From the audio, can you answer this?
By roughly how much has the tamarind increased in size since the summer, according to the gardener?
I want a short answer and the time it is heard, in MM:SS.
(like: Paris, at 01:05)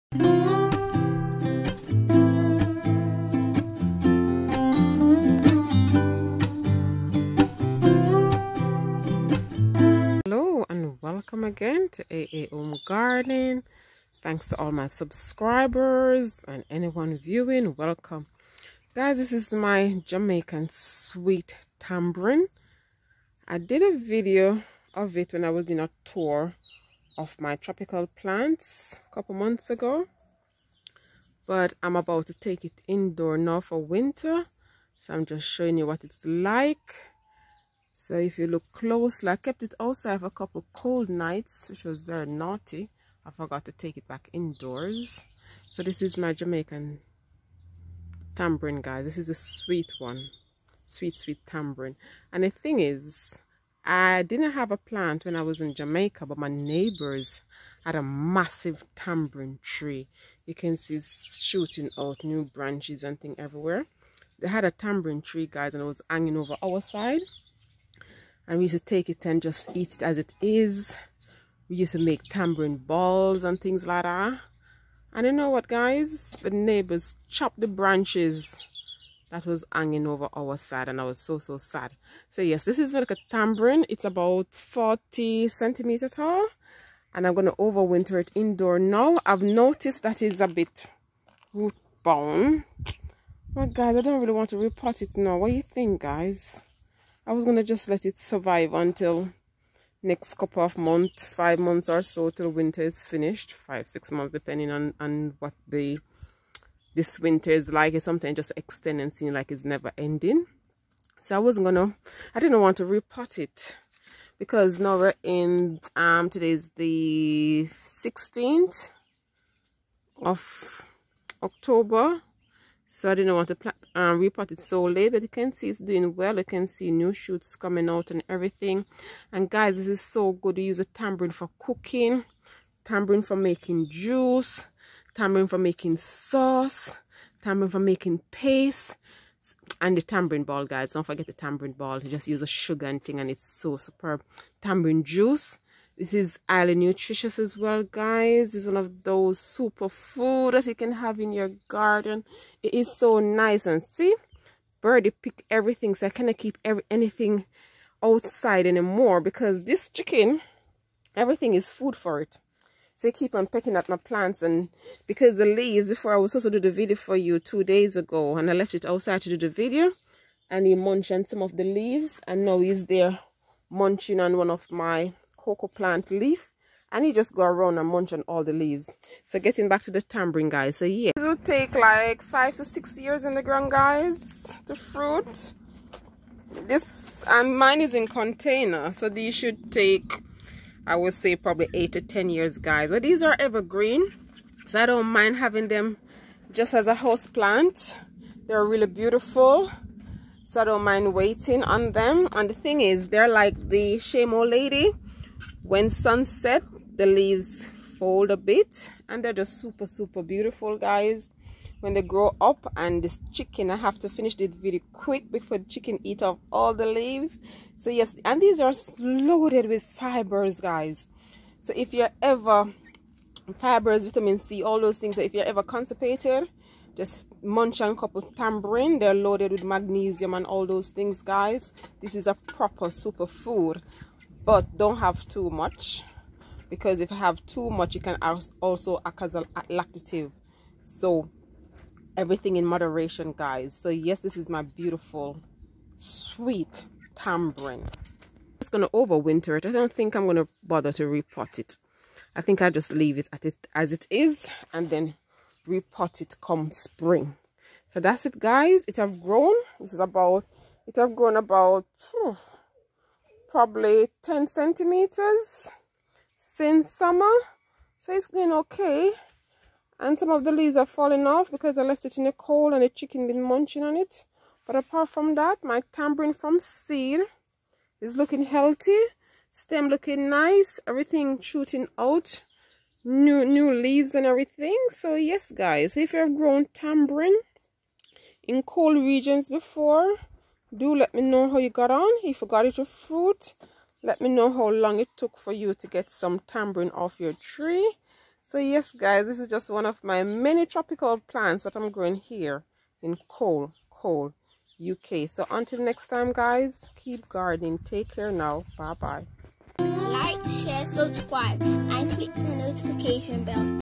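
10 centimeters, at 04:24.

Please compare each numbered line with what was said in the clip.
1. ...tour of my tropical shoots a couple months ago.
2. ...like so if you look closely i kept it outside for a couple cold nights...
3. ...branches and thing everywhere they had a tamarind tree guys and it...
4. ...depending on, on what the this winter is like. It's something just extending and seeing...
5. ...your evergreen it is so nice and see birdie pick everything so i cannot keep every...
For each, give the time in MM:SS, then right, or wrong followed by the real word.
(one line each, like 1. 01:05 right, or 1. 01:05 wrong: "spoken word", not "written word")
1. 00:26 wrong: "plants", not "shoots"
2. 00:36 right
3. 01:02 right
4. 01:44 right
5. 02:31 wrong: "garden", not "evergreen".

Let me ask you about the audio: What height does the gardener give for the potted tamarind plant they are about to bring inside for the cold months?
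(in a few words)
40 centimeters.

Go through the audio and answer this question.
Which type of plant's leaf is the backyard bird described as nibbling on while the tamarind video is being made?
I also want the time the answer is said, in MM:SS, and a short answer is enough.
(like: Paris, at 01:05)
cocoa plant, at 02:55.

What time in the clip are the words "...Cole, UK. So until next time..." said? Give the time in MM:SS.
05:03.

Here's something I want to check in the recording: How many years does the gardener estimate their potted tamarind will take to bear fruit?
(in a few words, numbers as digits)
8 to 10 years.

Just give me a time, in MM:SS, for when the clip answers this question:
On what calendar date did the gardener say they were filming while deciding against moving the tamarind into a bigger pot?
01:57.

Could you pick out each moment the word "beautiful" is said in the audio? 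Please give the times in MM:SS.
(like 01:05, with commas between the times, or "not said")
03:18, 03:30, 04:04.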